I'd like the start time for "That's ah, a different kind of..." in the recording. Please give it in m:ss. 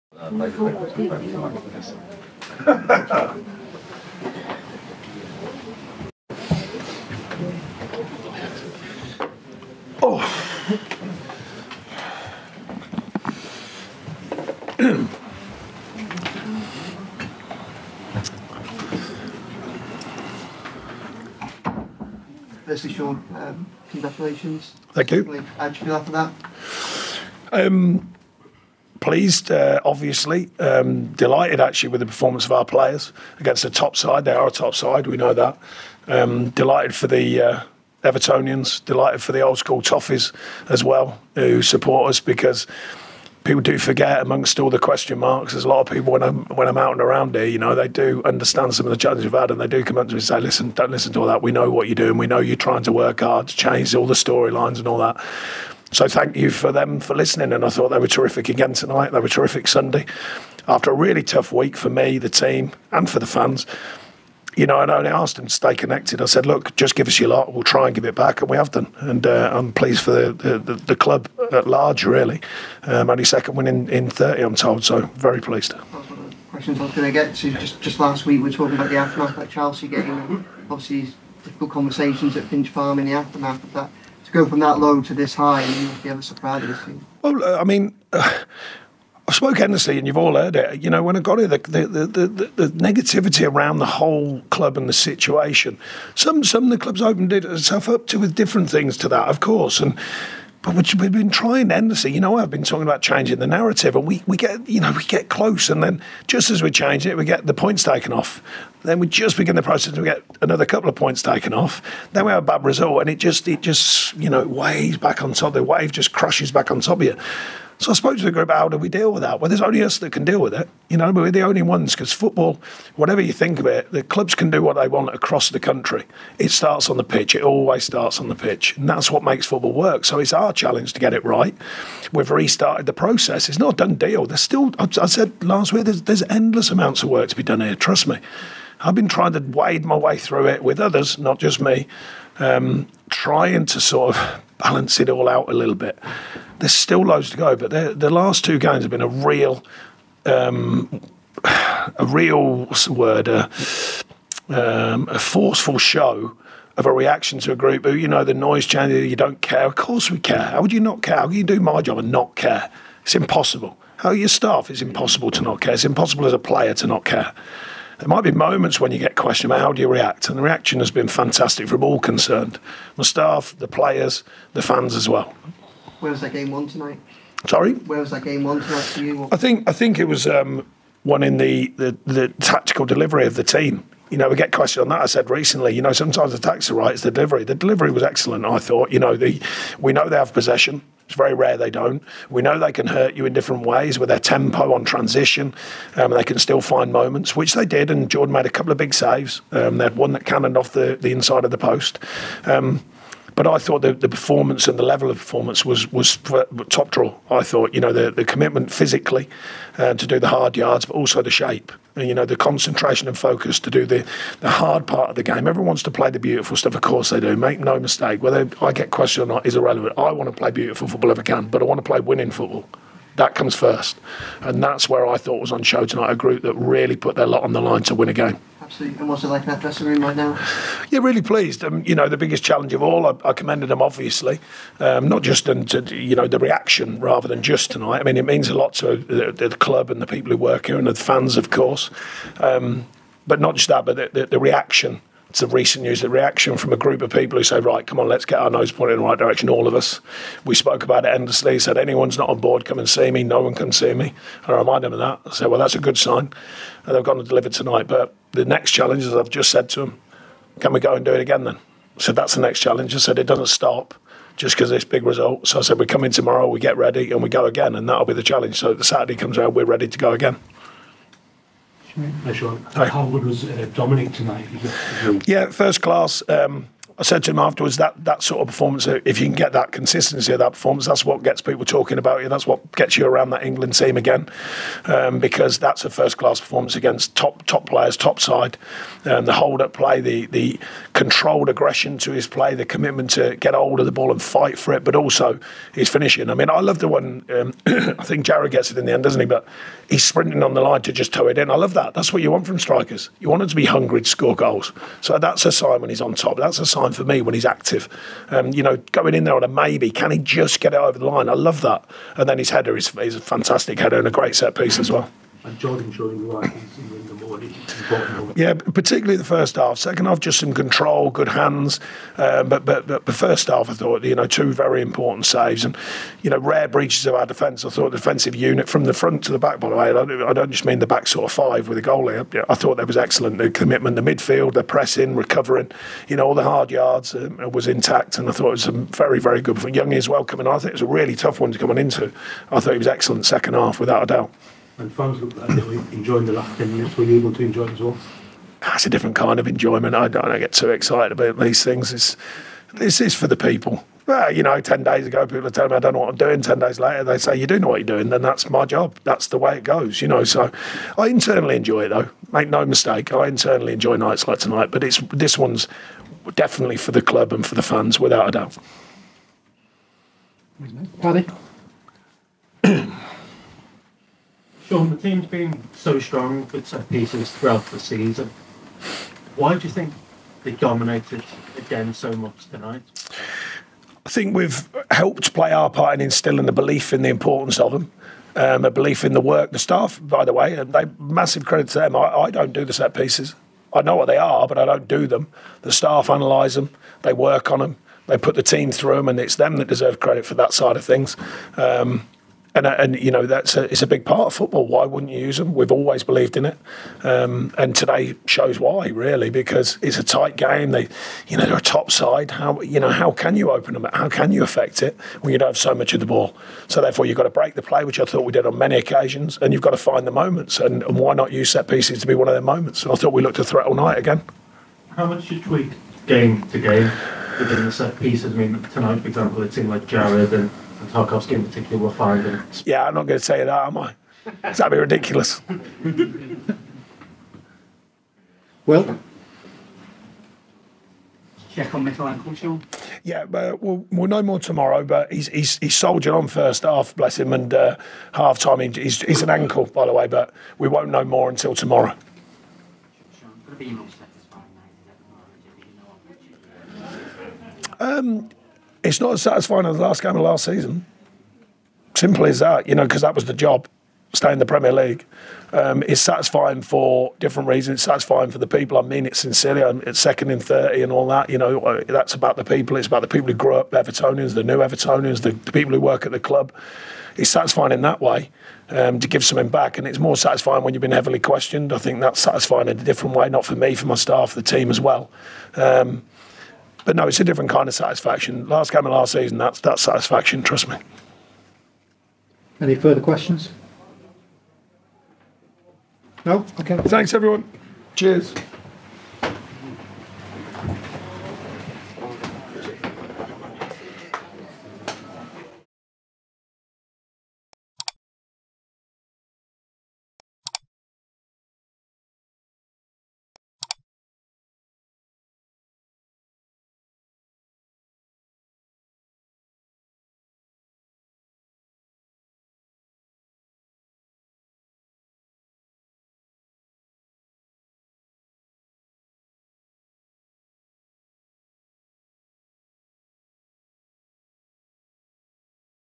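5:48.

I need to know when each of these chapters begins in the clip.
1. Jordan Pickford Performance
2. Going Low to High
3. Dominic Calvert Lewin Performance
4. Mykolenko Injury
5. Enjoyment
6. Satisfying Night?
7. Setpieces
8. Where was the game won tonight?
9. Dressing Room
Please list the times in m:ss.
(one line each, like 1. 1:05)
1. 5:19
2. 1:20
3. 4:32
4. 7:22
5. 5:46
6. 7:34
7. 6:20
8. 2:59
9. 3:51.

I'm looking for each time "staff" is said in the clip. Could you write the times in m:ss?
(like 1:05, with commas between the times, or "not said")
2:44, 2:53, 6:29, 6:35, 8:03.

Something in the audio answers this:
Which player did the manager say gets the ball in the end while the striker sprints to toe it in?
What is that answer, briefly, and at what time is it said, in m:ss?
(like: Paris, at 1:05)
Jared, at 4:58.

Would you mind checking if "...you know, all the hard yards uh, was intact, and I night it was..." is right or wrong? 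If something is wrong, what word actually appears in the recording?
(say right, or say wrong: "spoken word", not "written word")
wrong: "thought", not "night".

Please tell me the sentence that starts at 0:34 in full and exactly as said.
They are a top side, we know that.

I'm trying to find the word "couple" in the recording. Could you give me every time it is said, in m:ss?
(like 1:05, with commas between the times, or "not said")
1:50, 3:18.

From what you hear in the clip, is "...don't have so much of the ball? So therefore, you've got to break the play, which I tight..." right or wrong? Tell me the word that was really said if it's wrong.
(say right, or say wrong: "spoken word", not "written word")
wrong: "thought", not "tight".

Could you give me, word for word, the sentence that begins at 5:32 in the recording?
I, I thought that was excellent.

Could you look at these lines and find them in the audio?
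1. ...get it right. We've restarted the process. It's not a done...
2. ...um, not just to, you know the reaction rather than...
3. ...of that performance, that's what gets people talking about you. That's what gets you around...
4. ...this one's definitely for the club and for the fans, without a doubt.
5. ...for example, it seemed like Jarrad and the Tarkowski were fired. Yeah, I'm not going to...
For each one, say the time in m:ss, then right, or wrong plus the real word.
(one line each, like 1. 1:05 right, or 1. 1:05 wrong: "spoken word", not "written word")
1. 2:10 right
2. 3:54 right
3. 4:40 right
4. 6:05 right
5. 7:09 right.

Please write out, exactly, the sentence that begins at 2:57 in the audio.
Sorry, where was that game one tonight for you?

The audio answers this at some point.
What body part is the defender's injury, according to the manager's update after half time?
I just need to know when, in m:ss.
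7:29.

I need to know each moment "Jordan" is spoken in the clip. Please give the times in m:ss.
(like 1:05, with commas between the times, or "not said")
3:18, 5:15.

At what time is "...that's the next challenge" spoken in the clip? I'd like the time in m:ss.
4:22.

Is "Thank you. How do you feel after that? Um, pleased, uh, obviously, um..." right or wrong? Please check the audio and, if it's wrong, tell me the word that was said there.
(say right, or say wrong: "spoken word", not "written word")
right.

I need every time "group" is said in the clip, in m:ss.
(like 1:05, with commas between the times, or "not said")
1:58, 2:37, 3:46, 4:06.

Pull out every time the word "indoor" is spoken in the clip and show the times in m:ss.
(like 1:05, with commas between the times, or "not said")
not said.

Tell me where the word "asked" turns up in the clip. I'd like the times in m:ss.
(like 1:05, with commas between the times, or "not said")
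1:05.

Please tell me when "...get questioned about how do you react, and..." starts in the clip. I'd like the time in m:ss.
2:48.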